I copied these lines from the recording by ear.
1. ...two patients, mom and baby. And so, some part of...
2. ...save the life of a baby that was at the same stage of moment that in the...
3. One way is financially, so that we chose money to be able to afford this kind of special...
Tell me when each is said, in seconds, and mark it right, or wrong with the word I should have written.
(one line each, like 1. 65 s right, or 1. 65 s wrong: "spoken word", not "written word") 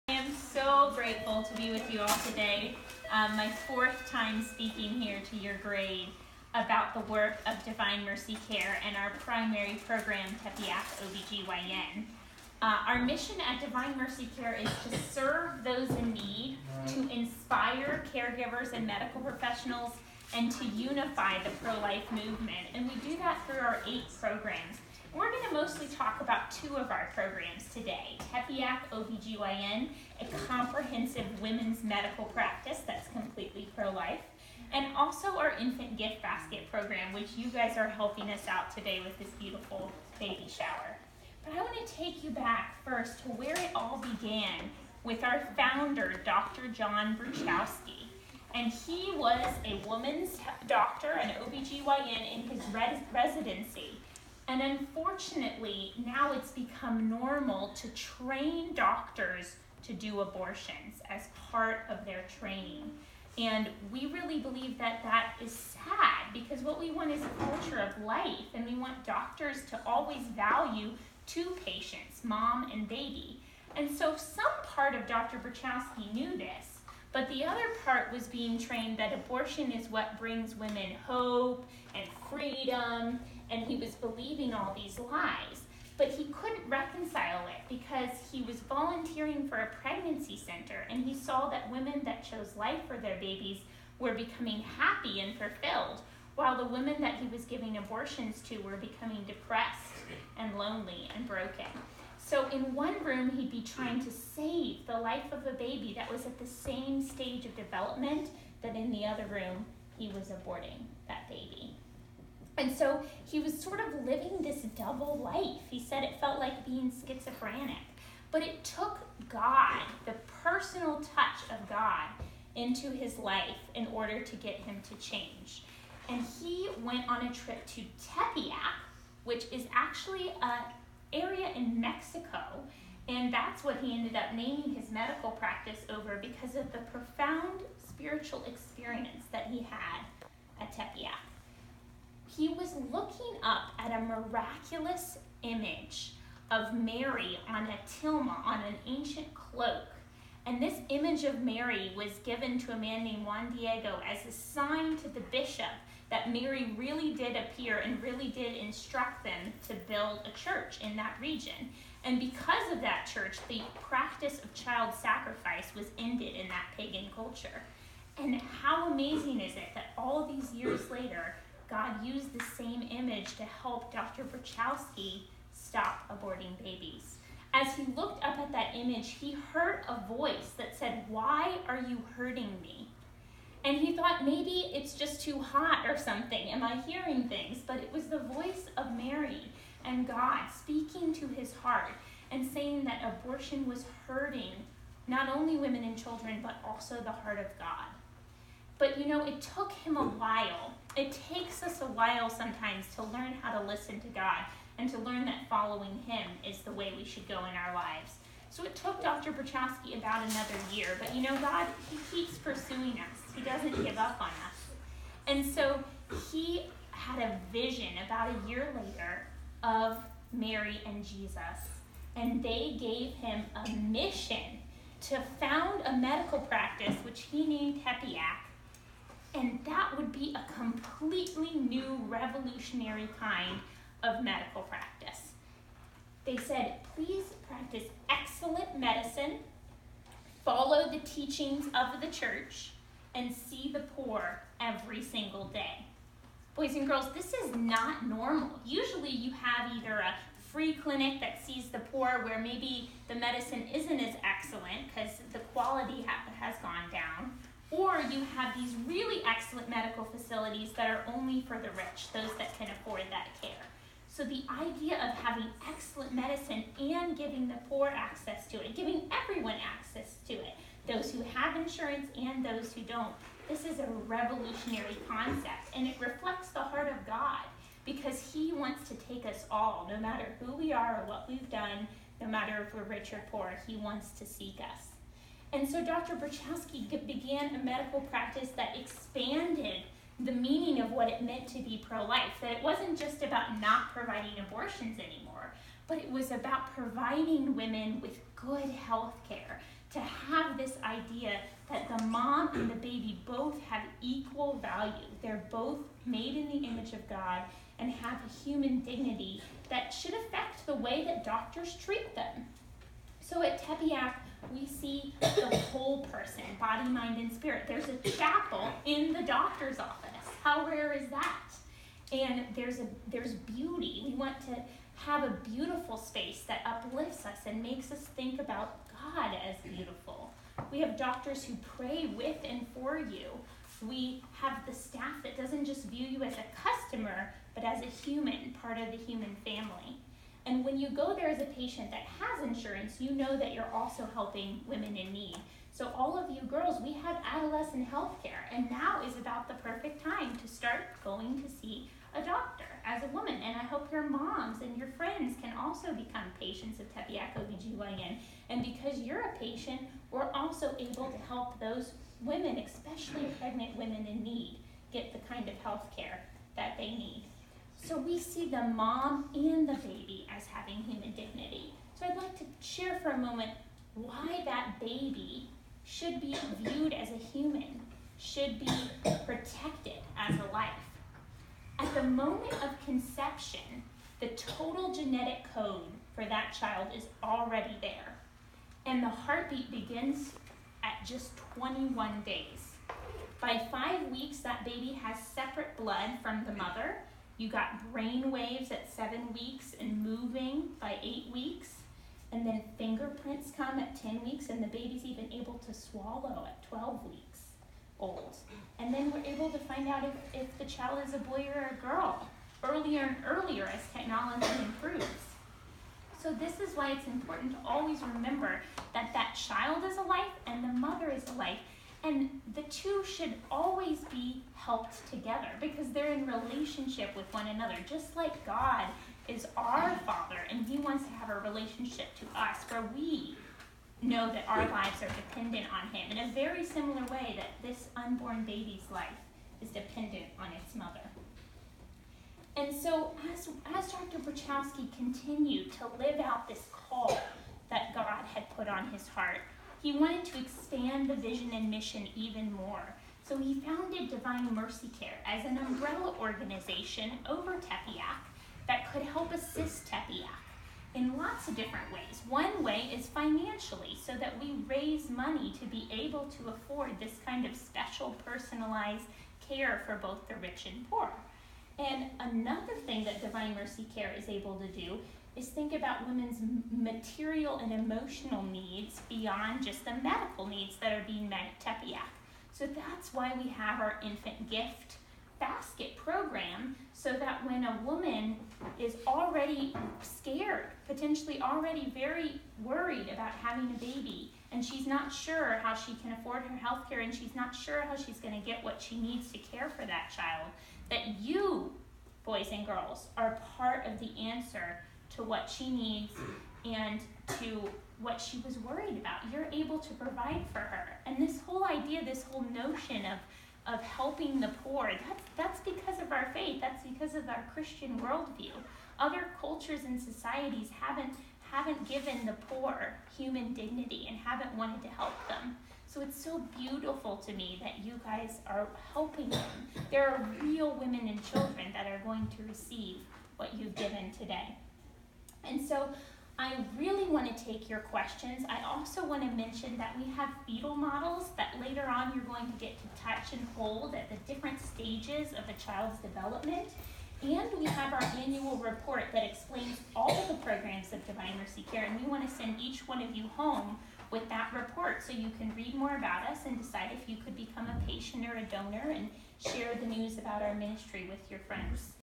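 1. 71 s right
2. 104 s wrong: "development", not "moment"
3. 462 s wrong: "raise", not "chose".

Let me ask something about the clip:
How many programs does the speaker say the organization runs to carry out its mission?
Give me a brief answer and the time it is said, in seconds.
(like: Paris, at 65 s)
8, at 23 s.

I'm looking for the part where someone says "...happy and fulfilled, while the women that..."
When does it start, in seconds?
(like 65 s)
94 s.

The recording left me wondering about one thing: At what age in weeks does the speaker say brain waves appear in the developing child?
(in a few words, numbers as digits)
7 weeks.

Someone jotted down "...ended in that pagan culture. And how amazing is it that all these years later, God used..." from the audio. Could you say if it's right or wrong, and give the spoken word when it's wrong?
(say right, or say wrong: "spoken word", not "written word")
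right.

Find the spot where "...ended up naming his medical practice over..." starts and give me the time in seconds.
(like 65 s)
133 s.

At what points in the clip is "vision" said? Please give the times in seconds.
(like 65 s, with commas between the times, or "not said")
217 s, 451 s.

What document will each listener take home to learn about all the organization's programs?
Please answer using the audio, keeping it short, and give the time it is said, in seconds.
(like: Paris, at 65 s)
annual report, at 548 s.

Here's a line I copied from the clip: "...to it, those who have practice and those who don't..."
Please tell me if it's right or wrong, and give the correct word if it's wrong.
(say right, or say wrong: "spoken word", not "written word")
wrong: "insurance", not "practice".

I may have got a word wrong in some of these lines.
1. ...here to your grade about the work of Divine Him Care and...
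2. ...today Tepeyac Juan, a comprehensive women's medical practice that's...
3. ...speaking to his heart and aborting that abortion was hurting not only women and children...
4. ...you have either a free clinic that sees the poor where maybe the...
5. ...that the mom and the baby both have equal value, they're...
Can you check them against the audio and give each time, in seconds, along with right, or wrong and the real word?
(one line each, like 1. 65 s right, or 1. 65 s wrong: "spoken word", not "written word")
1. 4 s wrong: "Mercy", not "Him"
2. 27 s wrong: "OBGYN", not "Juan"
3. 190 s wrong: "saying", not "aborting"
4. 249 s right
5. 301 s right.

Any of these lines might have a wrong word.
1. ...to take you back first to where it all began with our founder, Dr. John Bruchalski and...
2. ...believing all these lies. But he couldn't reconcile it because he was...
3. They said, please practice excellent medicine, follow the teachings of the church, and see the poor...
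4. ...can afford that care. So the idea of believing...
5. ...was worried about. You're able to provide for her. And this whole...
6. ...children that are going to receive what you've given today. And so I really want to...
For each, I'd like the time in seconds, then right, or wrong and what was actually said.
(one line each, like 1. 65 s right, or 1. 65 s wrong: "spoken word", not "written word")
1. 41 s right
2. 83 s right
3. 236 s right
4. 262 s wrong: "having", not "believing"
5. 508 s right
6. 531 s right.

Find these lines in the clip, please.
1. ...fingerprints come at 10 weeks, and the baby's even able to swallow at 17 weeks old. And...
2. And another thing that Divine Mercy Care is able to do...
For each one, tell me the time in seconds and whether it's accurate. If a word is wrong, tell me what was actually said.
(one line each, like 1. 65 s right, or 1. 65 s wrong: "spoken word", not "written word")
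1. 402 s wrong: "12", not "17"
2. 471 s right.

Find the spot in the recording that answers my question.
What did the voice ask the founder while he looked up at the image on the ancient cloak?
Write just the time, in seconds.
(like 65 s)
181 s.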